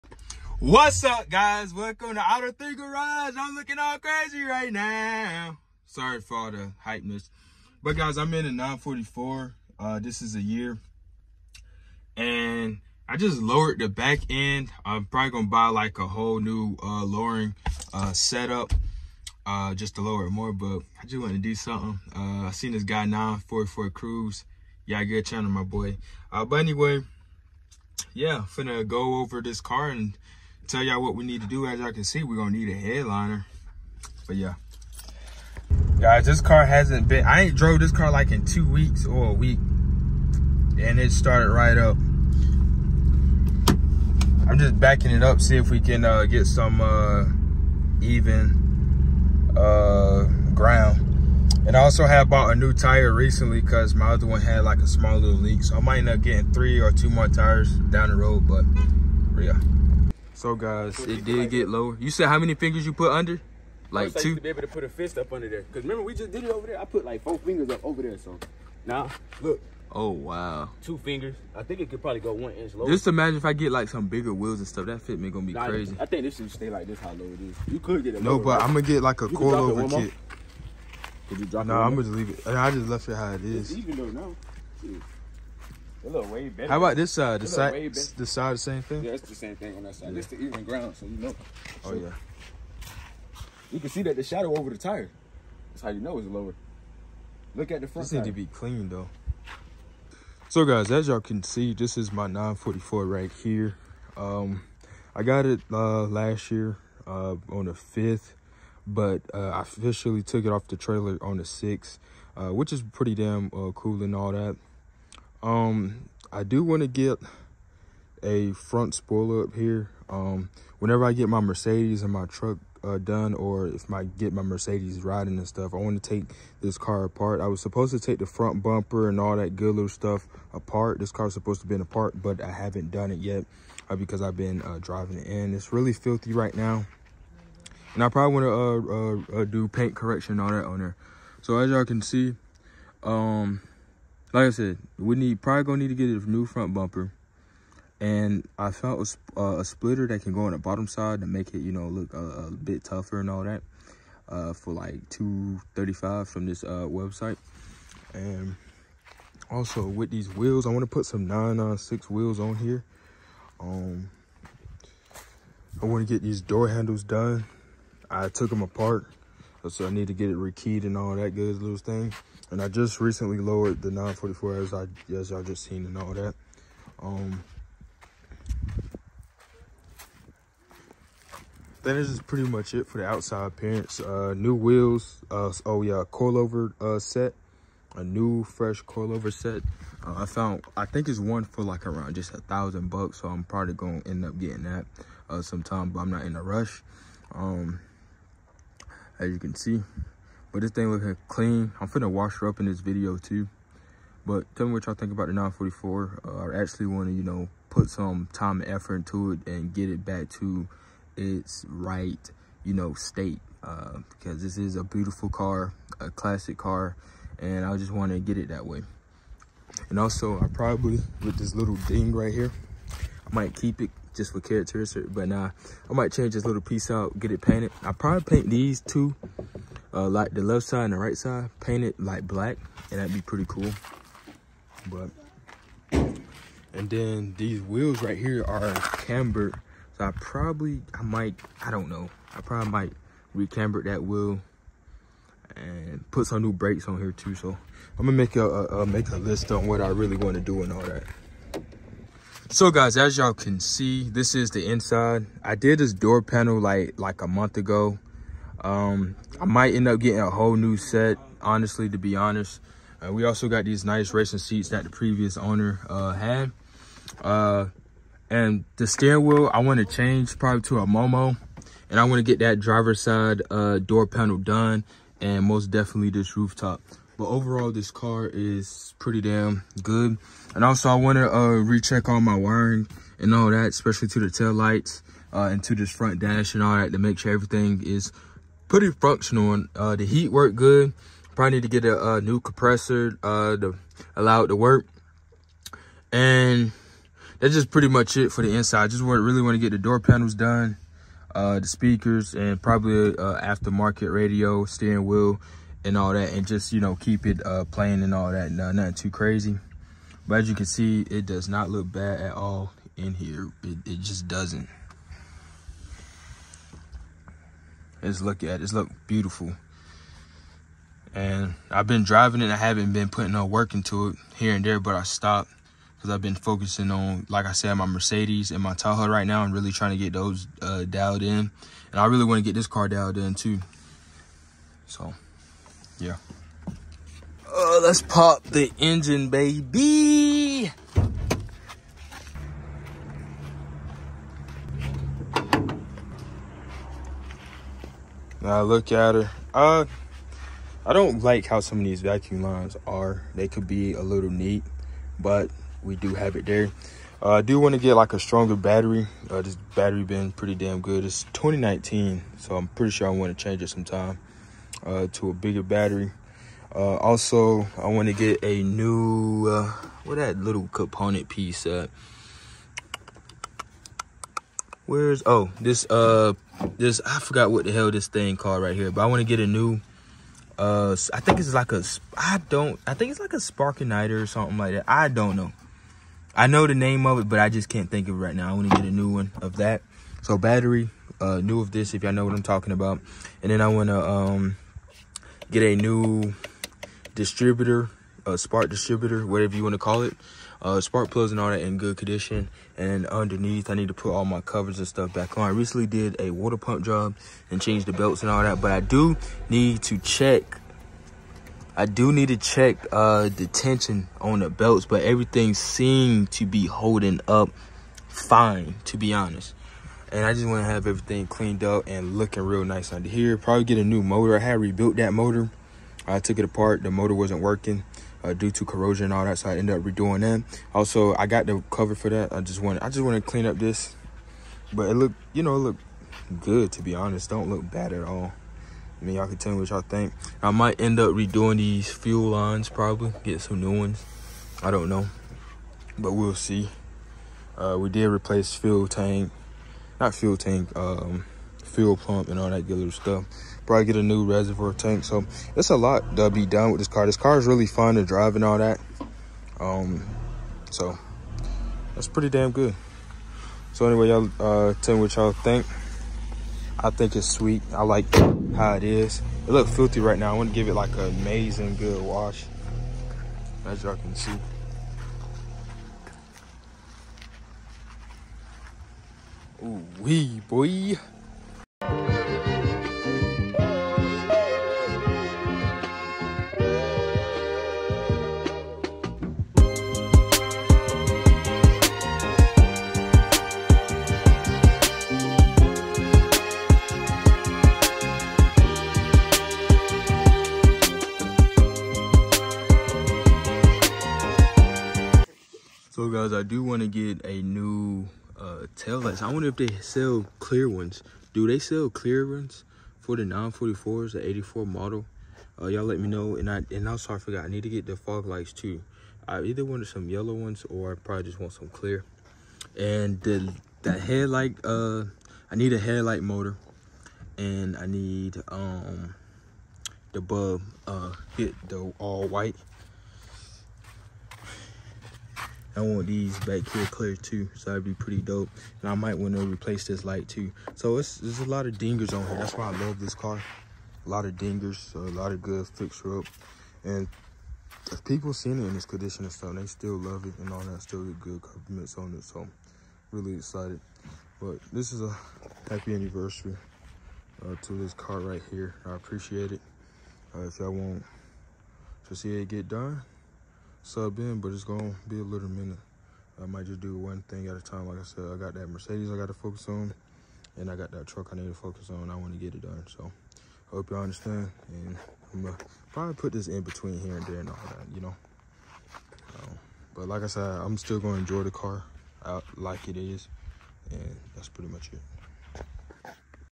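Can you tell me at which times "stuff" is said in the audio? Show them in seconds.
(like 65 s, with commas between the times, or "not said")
74 s, 125 s, 129 s, 404 s, 452 s, 549 s.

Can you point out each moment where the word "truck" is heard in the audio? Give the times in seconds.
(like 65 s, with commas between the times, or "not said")
122 s, 571 s.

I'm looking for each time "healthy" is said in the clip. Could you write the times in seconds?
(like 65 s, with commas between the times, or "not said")
not said.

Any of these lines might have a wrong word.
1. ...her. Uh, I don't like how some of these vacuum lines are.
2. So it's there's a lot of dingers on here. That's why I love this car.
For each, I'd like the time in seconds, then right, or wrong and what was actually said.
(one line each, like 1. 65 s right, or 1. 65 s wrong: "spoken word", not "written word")
1. 349 s right
2. 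540 s right.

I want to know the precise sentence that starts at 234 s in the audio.
But and then these wheels right here are cambered.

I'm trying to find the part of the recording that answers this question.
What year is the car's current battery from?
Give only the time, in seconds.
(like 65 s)
361 s.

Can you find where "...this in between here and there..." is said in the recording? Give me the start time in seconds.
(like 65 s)
576 s.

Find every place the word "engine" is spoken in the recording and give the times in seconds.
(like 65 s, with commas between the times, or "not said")
338 s.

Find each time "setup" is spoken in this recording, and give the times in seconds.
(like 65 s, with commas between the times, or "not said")
18 s.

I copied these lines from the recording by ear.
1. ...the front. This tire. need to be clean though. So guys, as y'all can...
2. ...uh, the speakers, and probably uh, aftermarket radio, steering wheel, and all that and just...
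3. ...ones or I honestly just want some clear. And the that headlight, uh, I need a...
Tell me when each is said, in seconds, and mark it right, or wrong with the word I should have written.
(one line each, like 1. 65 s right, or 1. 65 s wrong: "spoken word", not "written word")
1. 97 s right
2. 301 s right
3. 520 s wrong: "probably", not "honestly".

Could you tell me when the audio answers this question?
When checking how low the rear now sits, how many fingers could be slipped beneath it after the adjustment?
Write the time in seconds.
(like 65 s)
70 s.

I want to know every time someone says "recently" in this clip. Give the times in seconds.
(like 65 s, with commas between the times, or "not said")
53 s, 172 s, 405 s.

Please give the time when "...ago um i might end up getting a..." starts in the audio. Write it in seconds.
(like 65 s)
257 s.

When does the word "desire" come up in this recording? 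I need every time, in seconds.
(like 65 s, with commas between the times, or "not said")
not said.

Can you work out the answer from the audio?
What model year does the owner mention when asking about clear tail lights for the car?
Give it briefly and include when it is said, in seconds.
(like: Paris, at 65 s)
1984, at 514 s.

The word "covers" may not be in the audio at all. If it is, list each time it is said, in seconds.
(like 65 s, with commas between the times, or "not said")
404 s, 431 s.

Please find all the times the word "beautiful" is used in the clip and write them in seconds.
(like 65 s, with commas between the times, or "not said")
214 s, 319 s.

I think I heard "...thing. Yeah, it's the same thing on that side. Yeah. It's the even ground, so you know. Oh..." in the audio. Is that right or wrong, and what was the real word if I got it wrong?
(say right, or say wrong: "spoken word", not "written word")
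right.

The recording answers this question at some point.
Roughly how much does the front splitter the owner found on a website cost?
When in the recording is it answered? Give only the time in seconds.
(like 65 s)
155 s.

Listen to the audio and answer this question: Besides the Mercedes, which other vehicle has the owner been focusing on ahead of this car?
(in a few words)
Tahoe.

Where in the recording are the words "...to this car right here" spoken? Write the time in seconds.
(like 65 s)
557 s.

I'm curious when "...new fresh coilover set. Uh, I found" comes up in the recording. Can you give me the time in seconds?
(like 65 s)
188 s.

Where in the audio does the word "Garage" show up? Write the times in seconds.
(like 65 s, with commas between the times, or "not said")
2 s.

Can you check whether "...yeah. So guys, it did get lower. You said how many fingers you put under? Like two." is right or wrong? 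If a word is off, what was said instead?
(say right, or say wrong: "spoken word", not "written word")
right.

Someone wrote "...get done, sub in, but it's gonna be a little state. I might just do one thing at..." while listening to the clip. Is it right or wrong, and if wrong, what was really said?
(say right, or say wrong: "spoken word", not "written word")
wrong: "minute", not "state".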